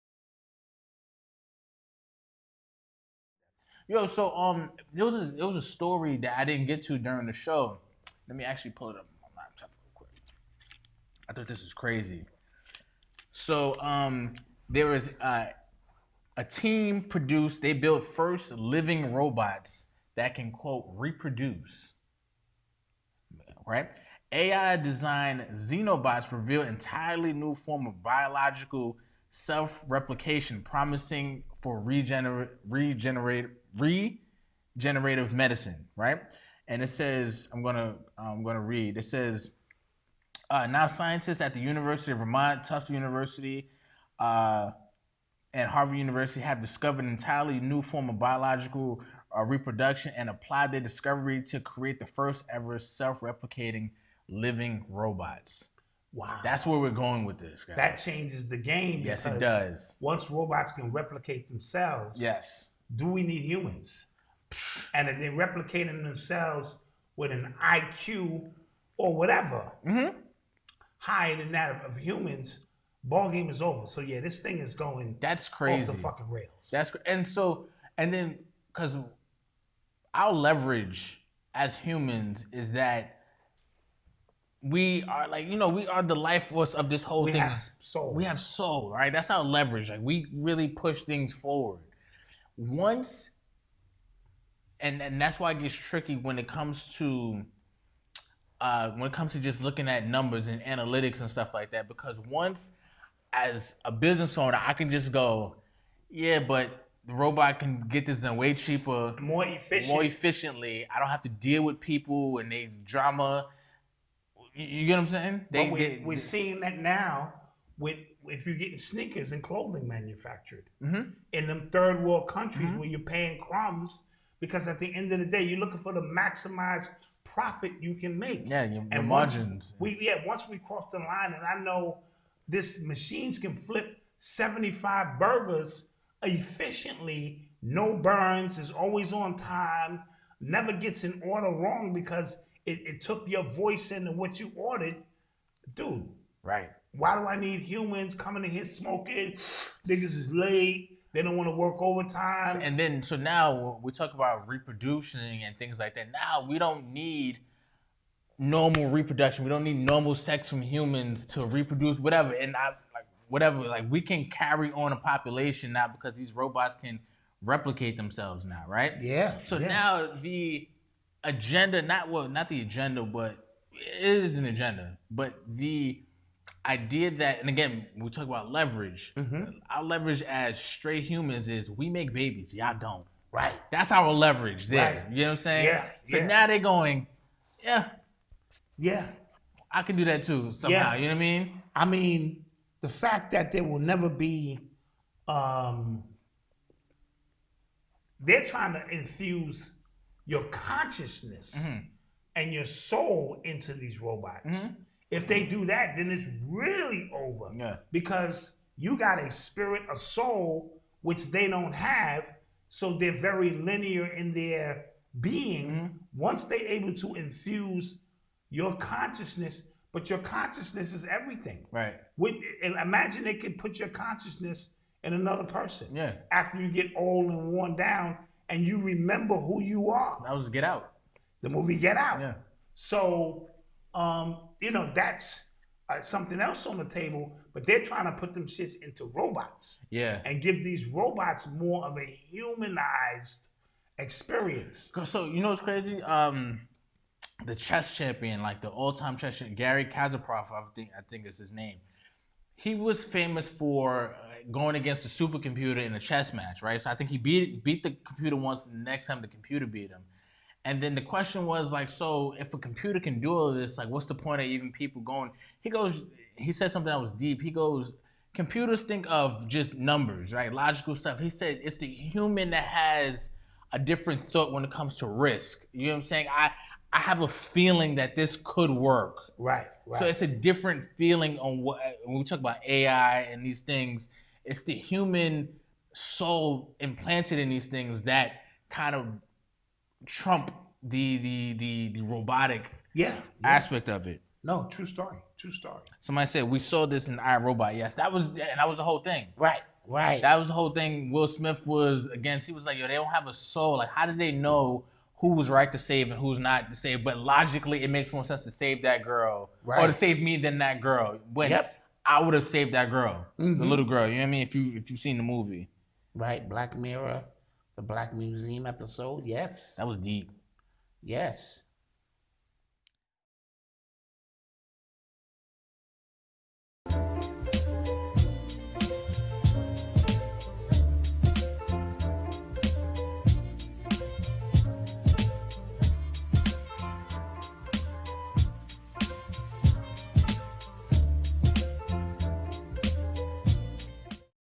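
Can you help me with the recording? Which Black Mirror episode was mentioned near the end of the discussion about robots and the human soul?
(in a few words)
Black Museum.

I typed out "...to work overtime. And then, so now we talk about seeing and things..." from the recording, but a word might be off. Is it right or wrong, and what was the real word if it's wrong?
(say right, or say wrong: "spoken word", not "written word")
wrong: "reproducing", not "seeing".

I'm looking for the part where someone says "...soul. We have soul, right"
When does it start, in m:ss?
1:27.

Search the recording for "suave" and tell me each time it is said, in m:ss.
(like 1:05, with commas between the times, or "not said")
not said.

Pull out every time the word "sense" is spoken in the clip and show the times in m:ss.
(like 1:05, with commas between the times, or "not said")
5:08.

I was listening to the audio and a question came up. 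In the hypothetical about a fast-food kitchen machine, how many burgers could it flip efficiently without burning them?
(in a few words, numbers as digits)
75.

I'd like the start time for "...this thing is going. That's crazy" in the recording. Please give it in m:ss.
1:14.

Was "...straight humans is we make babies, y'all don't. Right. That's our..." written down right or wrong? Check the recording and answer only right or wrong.
right.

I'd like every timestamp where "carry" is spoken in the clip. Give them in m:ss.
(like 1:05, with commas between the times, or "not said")
2:44.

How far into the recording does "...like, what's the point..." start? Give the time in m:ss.
4:23.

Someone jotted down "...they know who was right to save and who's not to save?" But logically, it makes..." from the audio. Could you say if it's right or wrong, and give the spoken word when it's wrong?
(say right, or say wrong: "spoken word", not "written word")
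right.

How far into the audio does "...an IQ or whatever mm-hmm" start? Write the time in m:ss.
1:07.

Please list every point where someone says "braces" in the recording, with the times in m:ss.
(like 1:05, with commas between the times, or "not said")
not said.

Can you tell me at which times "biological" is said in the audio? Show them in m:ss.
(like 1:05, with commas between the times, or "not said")
0:28, 0:48.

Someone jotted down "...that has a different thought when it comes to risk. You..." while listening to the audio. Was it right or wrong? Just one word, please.
right.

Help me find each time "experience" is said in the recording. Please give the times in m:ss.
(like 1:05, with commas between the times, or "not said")
4:03.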